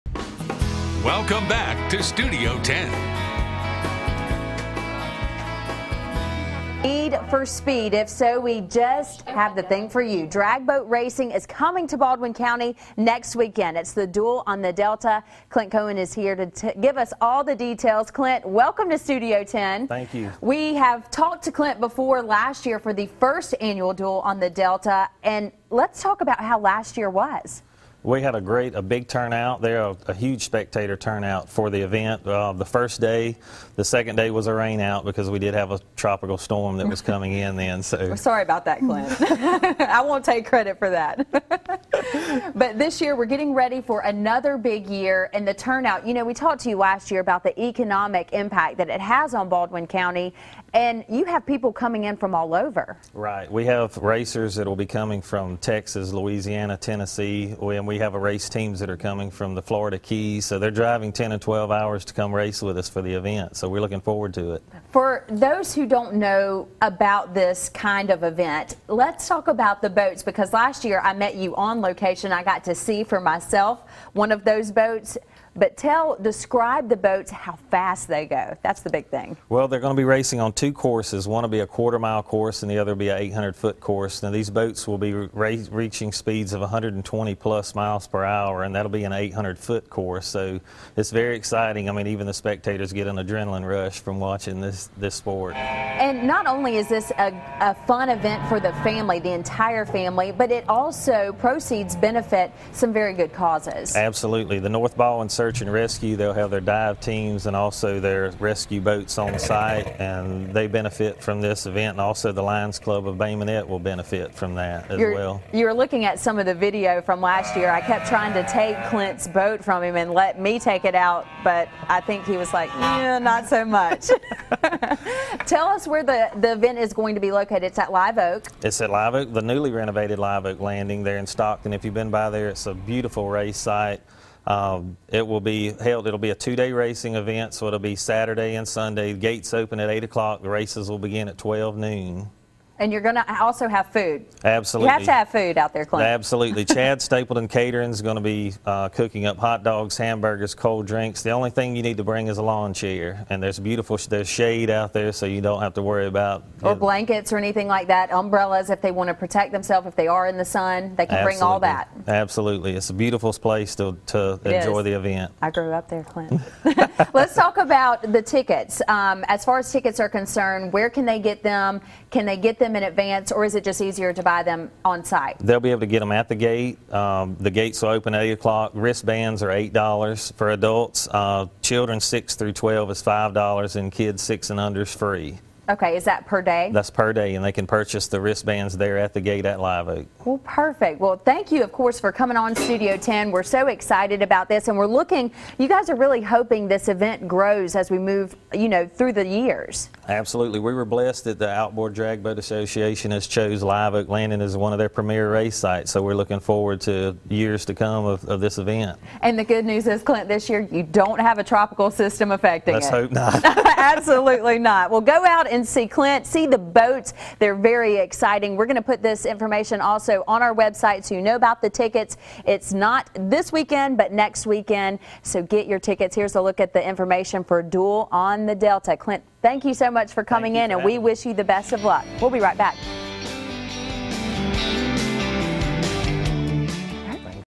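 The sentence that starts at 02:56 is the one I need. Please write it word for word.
Um, the gates will open at 8 o'clock.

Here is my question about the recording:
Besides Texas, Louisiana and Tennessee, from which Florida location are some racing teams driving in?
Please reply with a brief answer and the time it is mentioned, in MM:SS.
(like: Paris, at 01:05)
Florida Keys, at 00:59.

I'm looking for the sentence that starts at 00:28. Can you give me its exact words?
We had a great, a big turnout.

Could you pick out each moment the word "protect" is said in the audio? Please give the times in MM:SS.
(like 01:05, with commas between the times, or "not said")
02:39.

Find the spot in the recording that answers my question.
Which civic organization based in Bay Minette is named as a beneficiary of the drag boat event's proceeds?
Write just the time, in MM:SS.
01:52.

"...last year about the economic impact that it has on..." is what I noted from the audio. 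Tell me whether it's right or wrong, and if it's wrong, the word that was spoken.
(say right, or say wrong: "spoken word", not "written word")
right.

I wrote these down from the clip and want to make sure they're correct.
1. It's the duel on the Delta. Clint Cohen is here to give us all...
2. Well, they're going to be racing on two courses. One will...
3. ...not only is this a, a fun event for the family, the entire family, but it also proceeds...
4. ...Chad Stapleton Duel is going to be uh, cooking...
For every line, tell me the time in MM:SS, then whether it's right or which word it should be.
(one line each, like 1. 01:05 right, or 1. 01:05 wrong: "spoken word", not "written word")
1. 00:13 right
2. 01:19 right
3. 01:36 right
4. 02:26 wrong: "Catering", not "Duel".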